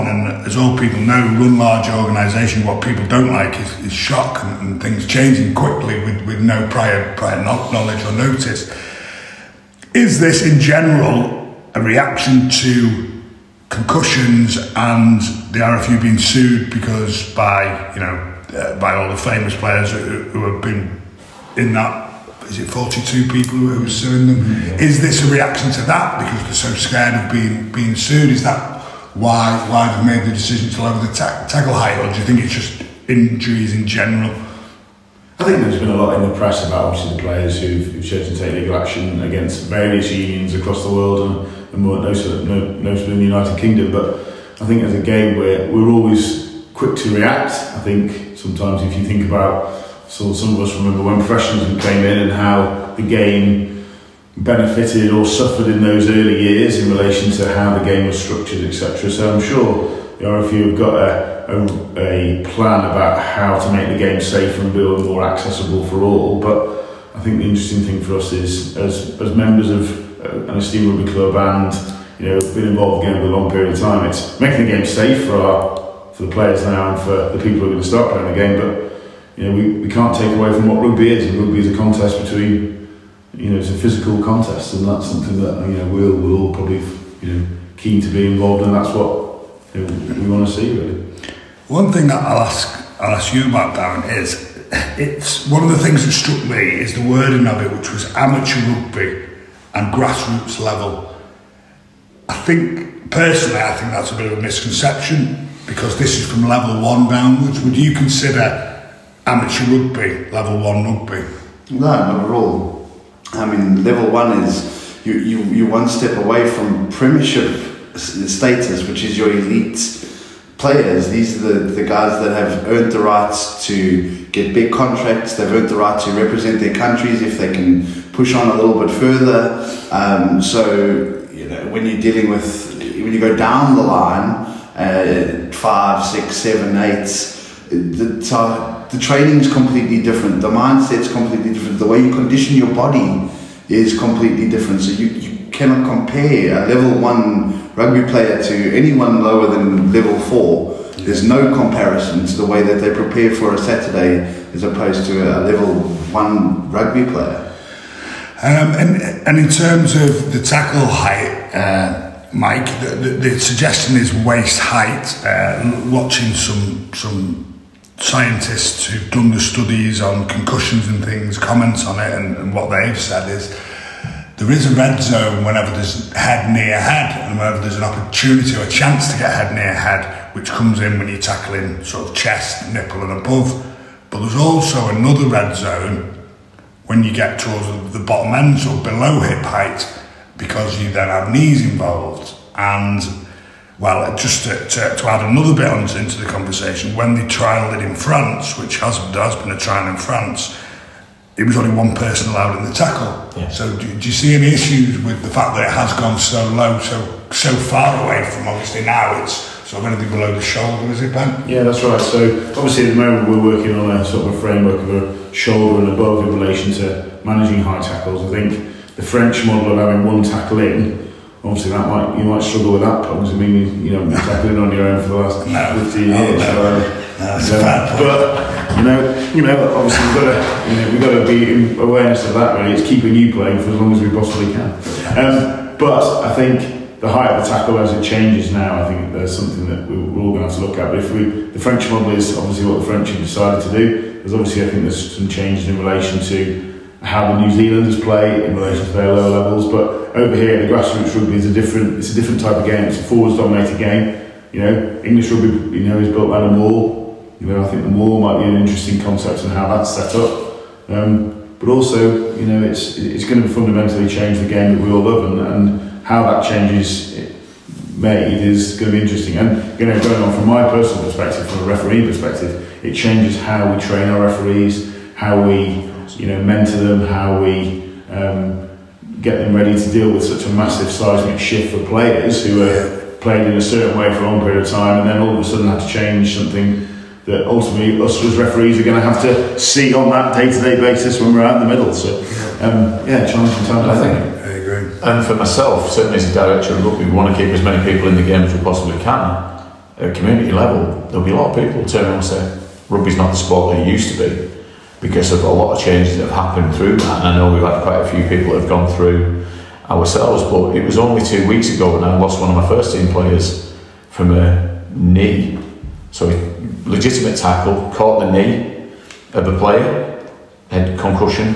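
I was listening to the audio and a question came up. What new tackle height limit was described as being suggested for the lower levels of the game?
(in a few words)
Waist height.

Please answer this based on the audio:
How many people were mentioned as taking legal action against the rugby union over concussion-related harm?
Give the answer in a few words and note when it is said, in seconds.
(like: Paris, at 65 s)
42, at 22 s.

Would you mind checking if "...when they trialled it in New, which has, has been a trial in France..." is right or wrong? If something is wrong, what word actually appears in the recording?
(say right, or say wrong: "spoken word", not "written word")
wrong: "France", not "New".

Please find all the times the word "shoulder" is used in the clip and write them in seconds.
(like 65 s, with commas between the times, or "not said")
210 s, 215 s.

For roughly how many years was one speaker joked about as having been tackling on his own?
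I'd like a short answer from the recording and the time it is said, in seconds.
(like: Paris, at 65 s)
15 years, at 225 s.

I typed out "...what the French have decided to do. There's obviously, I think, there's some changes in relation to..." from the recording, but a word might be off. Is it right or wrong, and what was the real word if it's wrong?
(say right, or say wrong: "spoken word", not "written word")
right.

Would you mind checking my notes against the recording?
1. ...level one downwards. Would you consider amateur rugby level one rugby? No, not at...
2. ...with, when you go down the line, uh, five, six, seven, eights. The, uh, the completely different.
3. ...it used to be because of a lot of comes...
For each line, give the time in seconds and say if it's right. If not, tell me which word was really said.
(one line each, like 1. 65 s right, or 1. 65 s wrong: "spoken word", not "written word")
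1. 106 s right
2. 132 s right
3. 303 s wrong: "changes", not "comes".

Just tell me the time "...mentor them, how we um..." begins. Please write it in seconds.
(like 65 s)
276 s.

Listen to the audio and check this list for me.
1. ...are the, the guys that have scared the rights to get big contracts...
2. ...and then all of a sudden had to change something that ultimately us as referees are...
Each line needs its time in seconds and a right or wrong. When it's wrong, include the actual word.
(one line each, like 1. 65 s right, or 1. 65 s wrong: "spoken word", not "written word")
1. 121 s wrong: "earned", not "scared"
2. 285 s right.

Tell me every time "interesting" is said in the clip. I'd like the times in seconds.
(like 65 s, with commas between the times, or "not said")
67 s, 258 s, 269 s.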